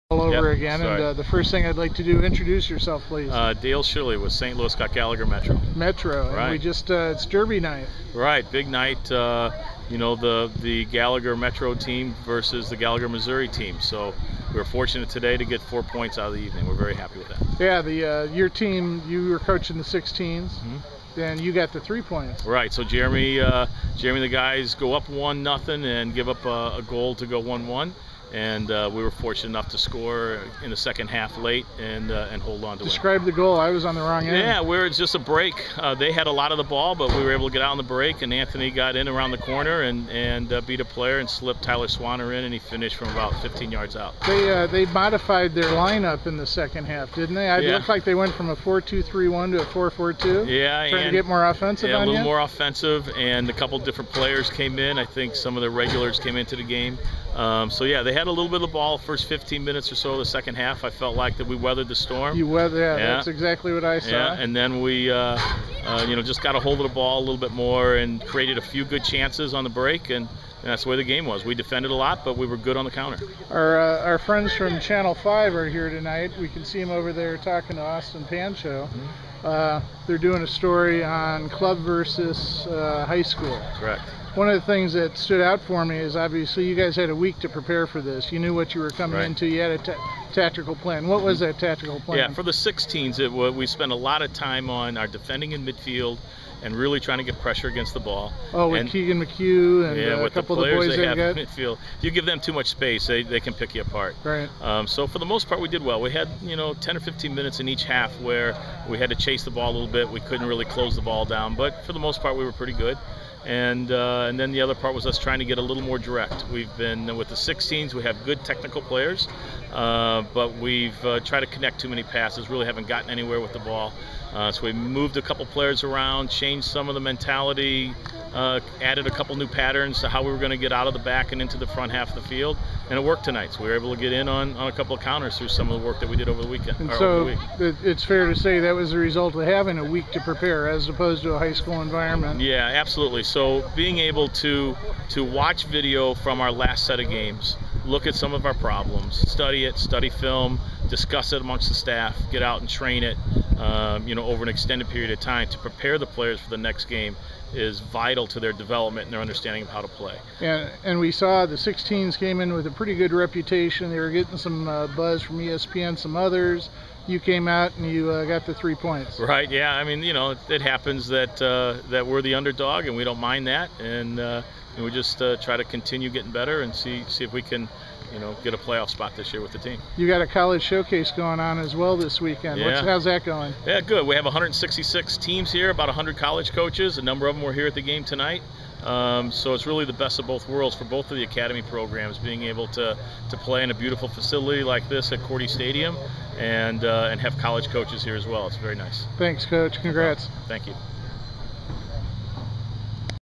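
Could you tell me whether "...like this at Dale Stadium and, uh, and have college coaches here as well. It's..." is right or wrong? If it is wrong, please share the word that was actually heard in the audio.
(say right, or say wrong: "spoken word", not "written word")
wrong: "Korte", not "Dale".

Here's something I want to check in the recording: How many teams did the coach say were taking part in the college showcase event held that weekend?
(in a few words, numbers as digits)
166.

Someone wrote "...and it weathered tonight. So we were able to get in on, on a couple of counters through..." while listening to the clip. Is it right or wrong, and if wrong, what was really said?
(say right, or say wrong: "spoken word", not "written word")
wrong: "worked", not "weathered".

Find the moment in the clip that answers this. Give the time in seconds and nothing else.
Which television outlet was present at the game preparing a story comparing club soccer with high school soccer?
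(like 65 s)
74 s.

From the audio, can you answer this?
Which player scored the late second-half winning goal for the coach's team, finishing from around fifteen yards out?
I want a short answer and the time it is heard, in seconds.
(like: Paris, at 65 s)
Tyler Swanner, at 41 s.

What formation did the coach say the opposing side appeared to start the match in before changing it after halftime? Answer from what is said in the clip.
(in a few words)
4-2-3-1.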